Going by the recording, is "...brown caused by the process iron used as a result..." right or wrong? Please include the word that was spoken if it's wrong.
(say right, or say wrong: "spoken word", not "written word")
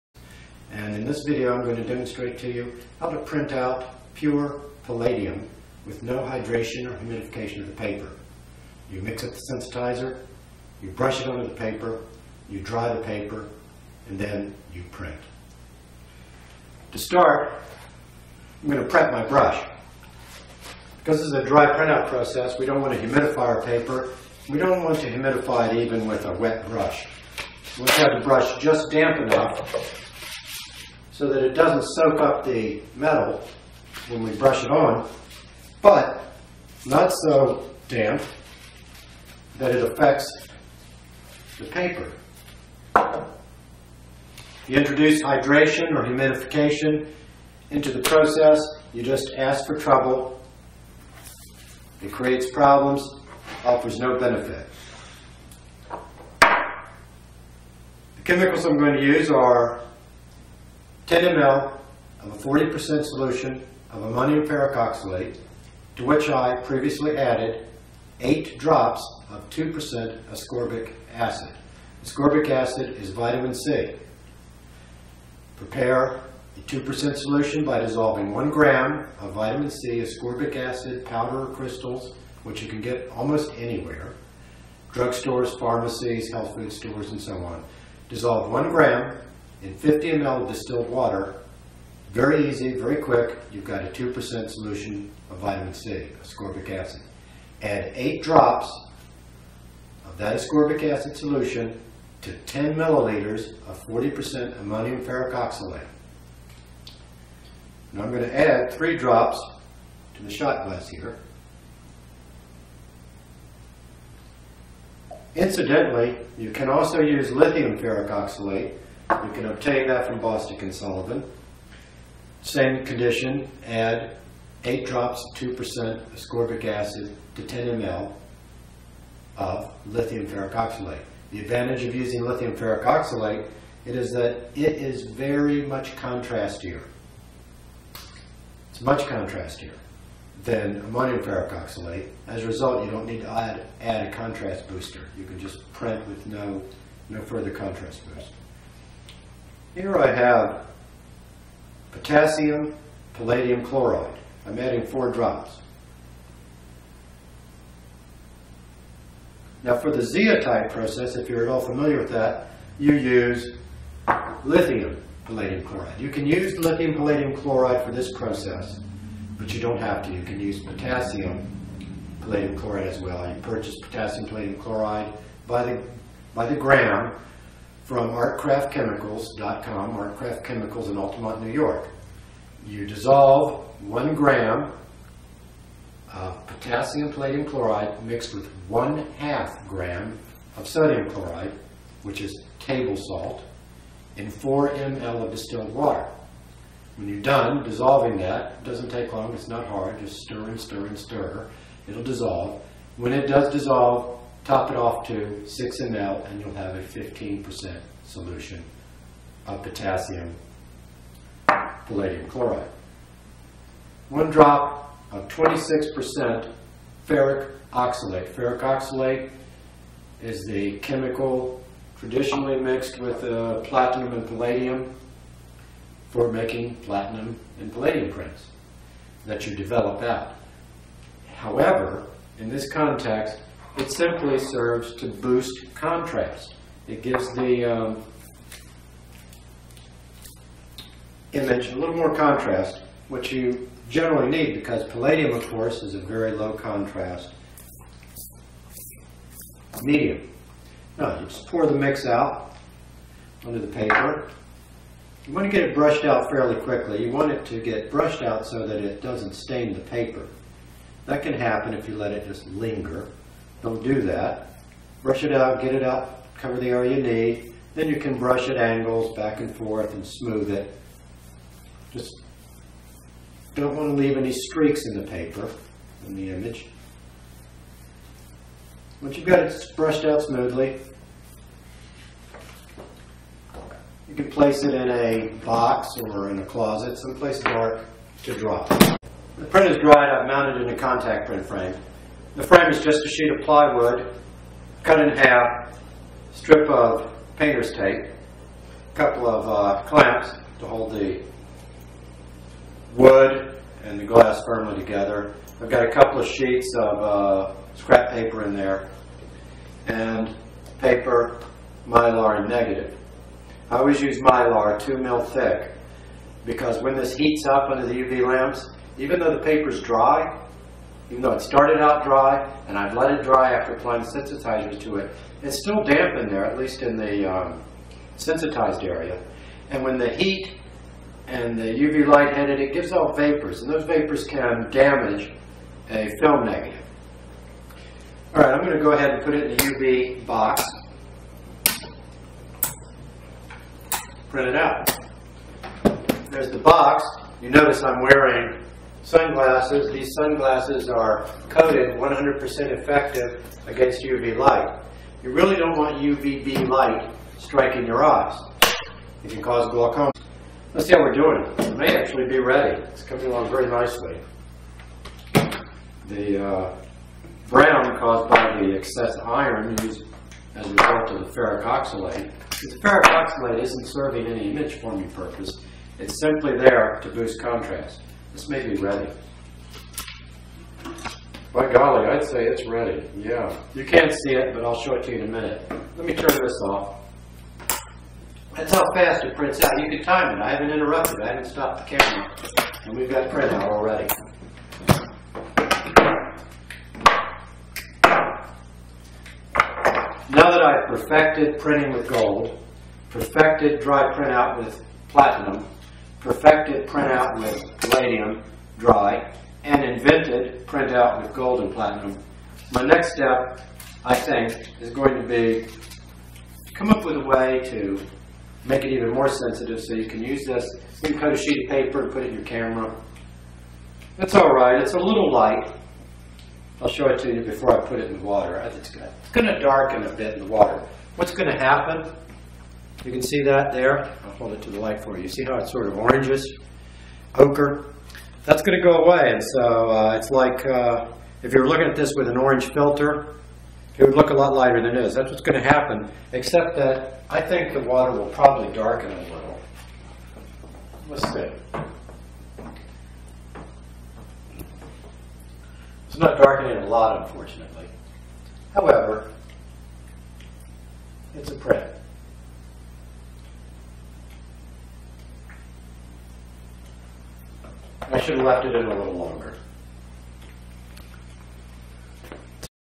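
wrong: "excess", not "process".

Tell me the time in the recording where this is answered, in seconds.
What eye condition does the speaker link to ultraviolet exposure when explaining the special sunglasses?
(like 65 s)
359 s.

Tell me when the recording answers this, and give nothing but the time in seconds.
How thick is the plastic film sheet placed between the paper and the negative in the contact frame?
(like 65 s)
314 s.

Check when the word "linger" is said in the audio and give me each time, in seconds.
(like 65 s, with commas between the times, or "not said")
262 s.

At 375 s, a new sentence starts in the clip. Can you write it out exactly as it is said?
It's simply there to boost contrast.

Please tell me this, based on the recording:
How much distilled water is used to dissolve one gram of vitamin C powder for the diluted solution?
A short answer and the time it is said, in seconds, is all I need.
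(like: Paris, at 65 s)
50 ml, at 89 s.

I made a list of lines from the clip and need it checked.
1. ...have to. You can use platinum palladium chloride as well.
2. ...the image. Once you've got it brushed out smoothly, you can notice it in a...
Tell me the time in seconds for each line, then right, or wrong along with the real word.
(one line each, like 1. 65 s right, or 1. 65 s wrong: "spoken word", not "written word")
1. 169 s wrong: "potassium", not "platinum"
2. 276 s wrong: "place", not "notice".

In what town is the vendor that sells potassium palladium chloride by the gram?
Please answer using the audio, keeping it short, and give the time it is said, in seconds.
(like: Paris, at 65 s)
Altamont, New York, at 180 s.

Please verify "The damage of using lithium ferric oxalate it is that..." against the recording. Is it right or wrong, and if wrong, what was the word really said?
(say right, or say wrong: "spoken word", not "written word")
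wrong: "advantage", not "damage".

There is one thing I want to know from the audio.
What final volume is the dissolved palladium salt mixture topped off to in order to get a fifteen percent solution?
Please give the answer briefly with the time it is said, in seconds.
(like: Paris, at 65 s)
6 ml, at 205 s.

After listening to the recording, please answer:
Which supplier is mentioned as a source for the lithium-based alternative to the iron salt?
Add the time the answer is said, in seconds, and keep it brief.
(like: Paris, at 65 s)
Bostick and Sullivan, at 120 s.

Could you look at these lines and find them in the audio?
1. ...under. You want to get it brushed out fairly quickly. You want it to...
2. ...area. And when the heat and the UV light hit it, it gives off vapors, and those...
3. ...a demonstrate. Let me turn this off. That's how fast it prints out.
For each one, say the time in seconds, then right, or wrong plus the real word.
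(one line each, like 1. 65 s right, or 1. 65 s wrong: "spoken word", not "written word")
1. 253 s wrong: "paper", not "under"
2. 328 s right
3. 385 s wrong: "minute", not "demonstrate".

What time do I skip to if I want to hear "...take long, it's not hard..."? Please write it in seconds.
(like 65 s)
198 s.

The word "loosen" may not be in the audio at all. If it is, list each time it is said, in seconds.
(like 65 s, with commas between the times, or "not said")
not said.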